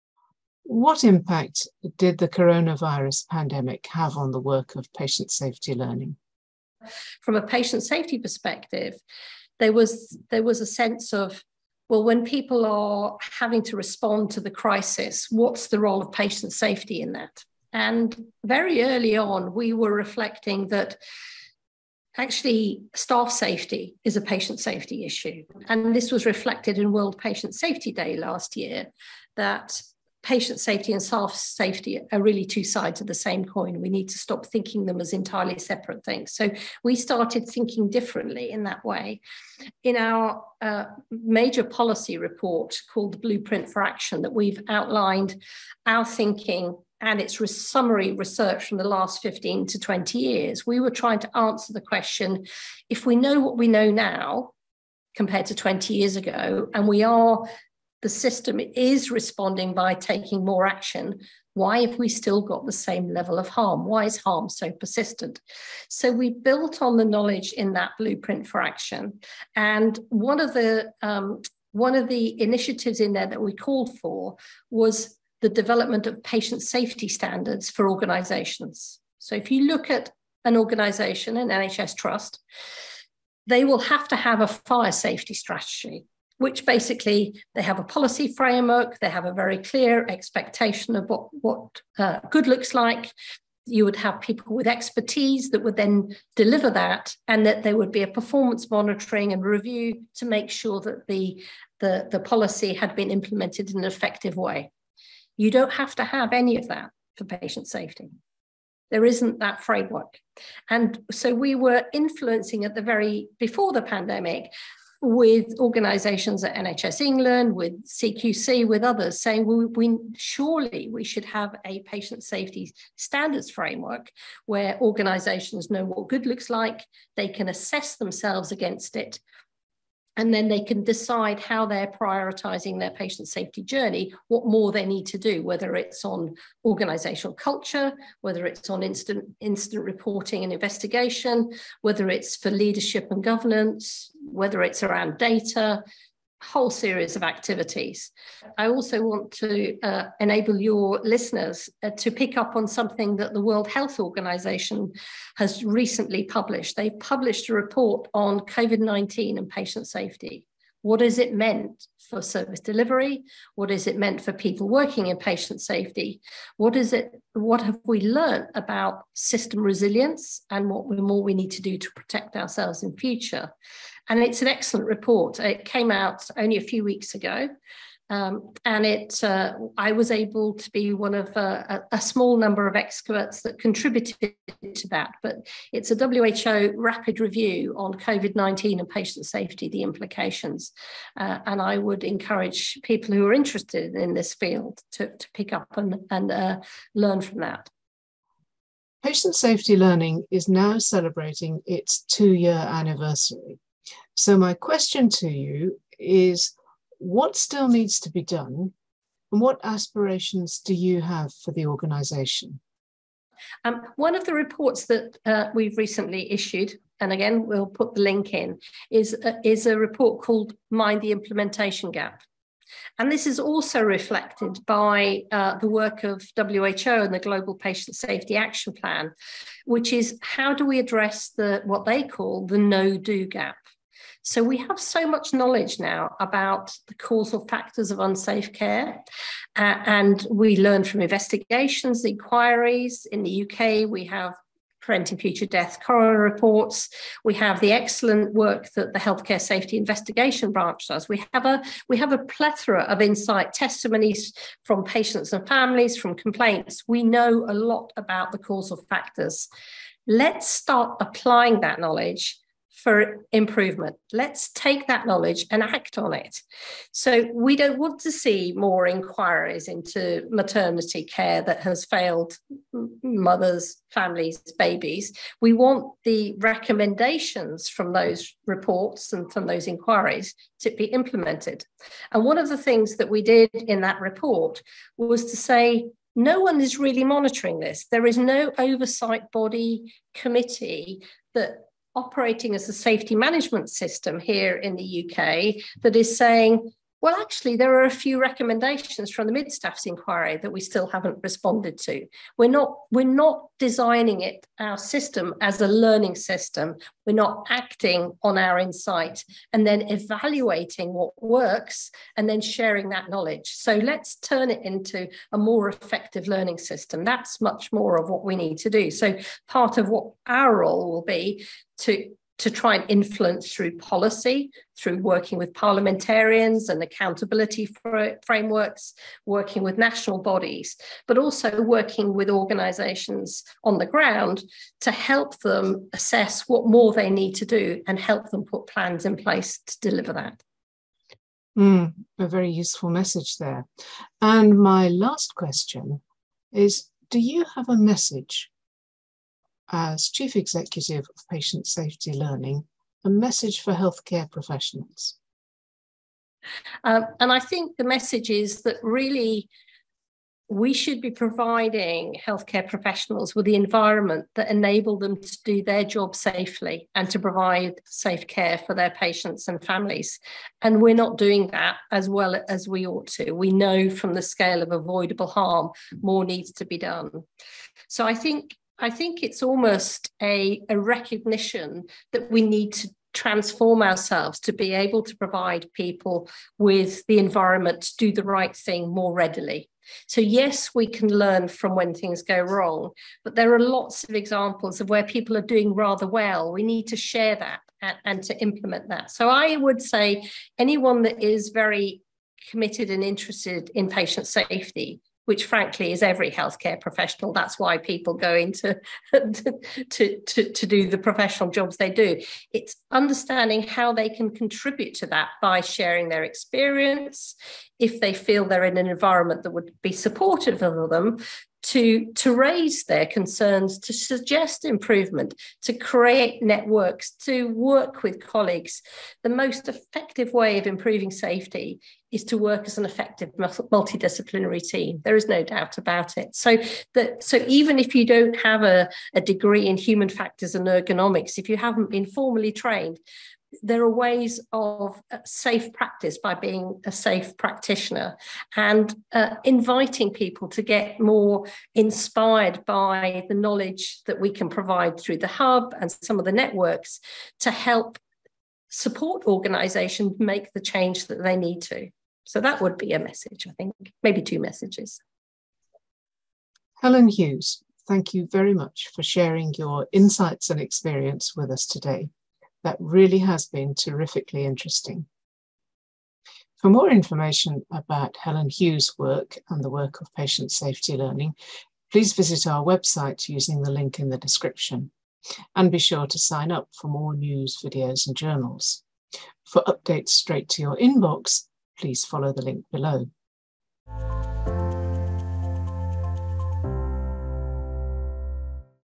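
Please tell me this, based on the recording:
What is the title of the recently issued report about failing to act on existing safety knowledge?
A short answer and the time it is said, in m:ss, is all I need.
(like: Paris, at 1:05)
Mind the Implementation Gap, at 3:40.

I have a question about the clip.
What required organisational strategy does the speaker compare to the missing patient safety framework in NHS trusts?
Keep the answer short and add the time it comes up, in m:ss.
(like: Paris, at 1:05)
fire safety strategy, at 1:24.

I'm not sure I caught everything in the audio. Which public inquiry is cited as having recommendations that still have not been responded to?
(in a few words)
Mid Staffs inquiry.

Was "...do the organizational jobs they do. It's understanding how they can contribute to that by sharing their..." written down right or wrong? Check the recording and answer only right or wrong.
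wrong.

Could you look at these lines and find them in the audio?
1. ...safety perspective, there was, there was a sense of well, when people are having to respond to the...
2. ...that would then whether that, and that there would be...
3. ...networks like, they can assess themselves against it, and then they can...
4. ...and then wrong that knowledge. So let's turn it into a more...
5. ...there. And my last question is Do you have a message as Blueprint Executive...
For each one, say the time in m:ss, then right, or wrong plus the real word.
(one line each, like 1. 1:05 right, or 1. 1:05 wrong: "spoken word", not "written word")
1. 0:07 right
2. 1:35 wrong: "deliver", not "whether"
3. 2:06 wrong: "looks", not "networks"
4. 5:12 wrong: "sharing", not "wrong"
5. 5:43 wrong: "Chief", not "Blueprint".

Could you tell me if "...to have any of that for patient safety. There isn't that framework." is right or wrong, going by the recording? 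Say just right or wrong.
right.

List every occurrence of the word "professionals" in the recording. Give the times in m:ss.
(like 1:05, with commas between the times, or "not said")
5:54, 6:02, 6:46, 6:50.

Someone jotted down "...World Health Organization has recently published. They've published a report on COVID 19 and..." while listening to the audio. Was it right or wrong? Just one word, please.
right.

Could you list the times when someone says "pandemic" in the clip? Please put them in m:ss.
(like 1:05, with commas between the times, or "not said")
0:03, 1:53.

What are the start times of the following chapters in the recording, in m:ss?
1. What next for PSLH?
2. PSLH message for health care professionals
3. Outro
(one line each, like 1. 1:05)
1. 4:02
2. 5:41
3. 7:46.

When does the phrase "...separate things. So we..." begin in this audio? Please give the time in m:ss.
0:35.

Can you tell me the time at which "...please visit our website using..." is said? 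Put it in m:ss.
8:01.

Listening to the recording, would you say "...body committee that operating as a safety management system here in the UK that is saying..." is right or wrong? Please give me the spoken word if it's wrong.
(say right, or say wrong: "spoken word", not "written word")
right.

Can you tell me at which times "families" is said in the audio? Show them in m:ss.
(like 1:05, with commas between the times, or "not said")
4:15, 4:33, 6:09.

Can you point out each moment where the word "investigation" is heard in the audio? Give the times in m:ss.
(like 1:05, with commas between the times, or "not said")
2:20, 4:01, 4:09.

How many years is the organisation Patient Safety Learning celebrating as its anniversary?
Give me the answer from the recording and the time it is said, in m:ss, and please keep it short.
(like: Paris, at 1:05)
2, at 3:22.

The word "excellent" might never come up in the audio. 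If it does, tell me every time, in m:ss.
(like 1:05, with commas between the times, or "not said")
2:54, 4:07.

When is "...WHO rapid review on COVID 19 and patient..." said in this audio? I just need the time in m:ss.
3:05.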